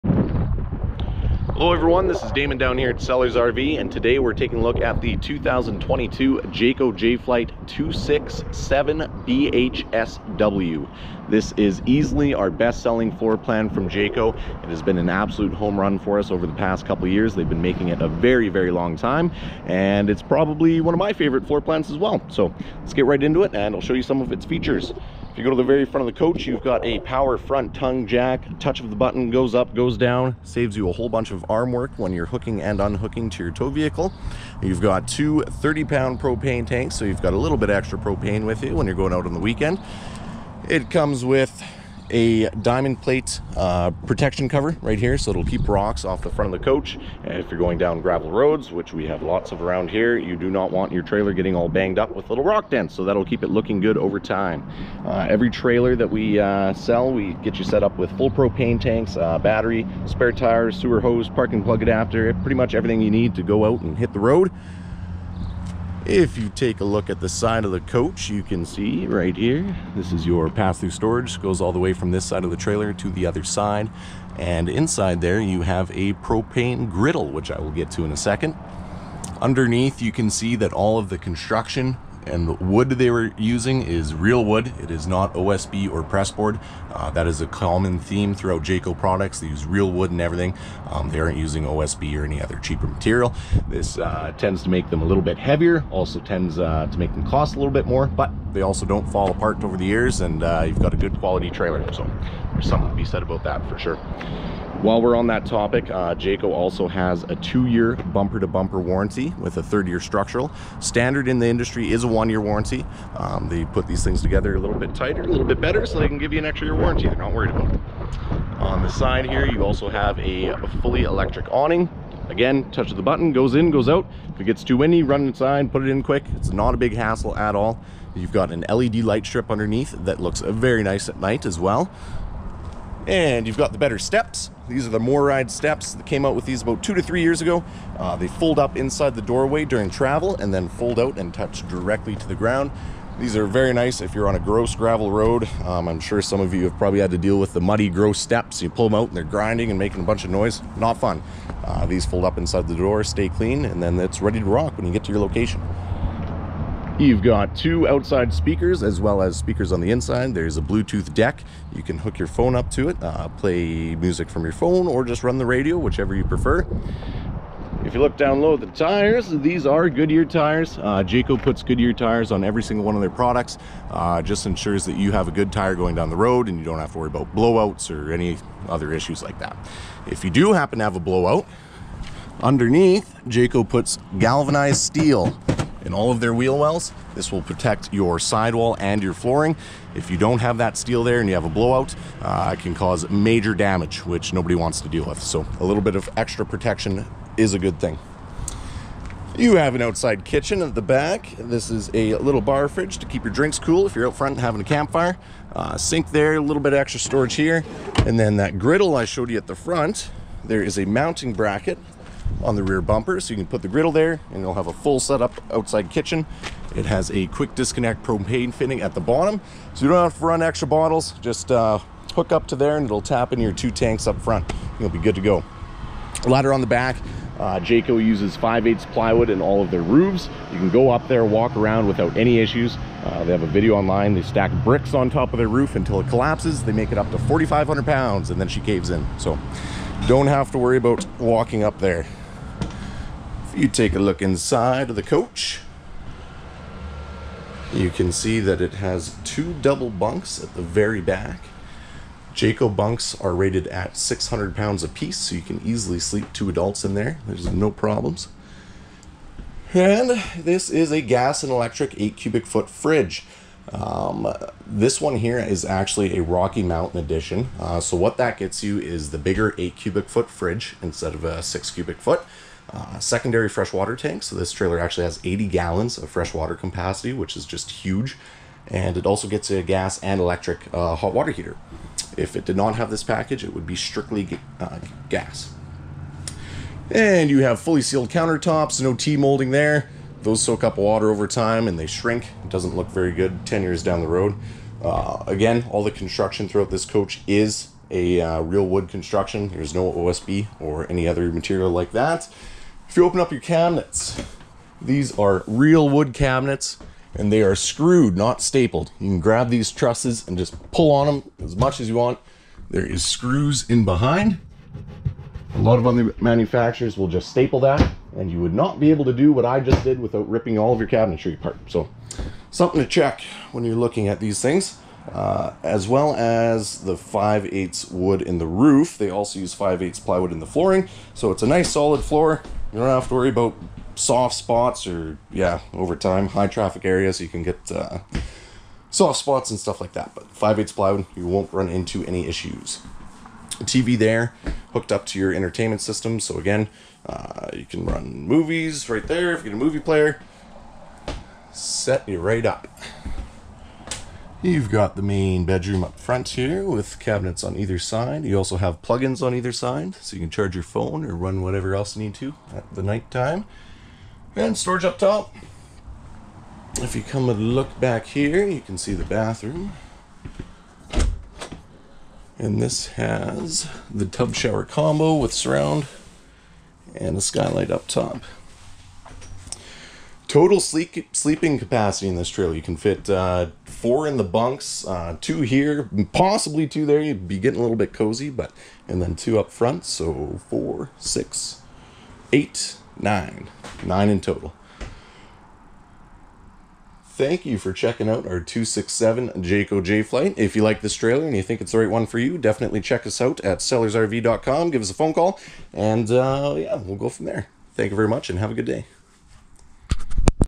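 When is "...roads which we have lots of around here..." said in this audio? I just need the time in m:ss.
0:48.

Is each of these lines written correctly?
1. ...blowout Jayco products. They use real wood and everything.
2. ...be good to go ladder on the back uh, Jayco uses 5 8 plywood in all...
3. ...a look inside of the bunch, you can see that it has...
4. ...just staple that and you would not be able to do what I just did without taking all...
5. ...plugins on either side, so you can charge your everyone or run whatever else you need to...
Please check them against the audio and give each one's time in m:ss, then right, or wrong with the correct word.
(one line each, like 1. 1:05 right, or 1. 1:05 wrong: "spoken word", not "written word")
1. 1:28 wrong: "throughout", not "blowout"
2. 3:44 right
3. 4:03 wrong: "coach", not "bunch"
4. 5:17 wrong: "ripping", not "taking"
5. 5:58 wrong: "phone", not "everyone".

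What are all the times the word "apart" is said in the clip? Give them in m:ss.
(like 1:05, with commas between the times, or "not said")
1:39, 5:21.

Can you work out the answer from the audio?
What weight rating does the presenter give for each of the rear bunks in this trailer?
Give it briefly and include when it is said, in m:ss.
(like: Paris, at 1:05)
600 pounds, at 4:13.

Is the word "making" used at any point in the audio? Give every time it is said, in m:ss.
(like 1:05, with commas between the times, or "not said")
0:17, 2:29.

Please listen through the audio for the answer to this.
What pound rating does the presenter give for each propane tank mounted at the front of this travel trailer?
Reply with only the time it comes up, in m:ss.
0:35.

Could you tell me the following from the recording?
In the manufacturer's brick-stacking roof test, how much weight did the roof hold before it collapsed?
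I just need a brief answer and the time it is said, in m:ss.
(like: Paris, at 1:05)
4,500 pounds, at 3:57.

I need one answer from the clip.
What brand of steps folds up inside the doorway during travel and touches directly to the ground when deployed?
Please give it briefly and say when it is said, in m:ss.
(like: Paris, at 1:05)
MORryde, at 2:14.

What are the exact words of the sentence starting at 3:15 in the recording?
So a little bit of extra protection is a good thing.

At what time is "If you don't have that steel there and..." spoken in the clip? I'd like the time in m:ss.
3:09.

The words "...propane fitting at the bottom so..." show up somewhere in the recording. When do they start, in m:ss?
3:38.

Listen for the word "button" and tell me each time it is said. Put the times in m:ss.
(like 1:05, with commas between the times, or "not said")
0:28, 2:03.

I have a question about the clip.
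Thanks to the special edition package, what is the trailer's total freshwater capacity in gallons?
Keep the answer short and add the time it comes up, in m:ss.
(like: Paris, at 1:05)
80 gallons, at 4:35.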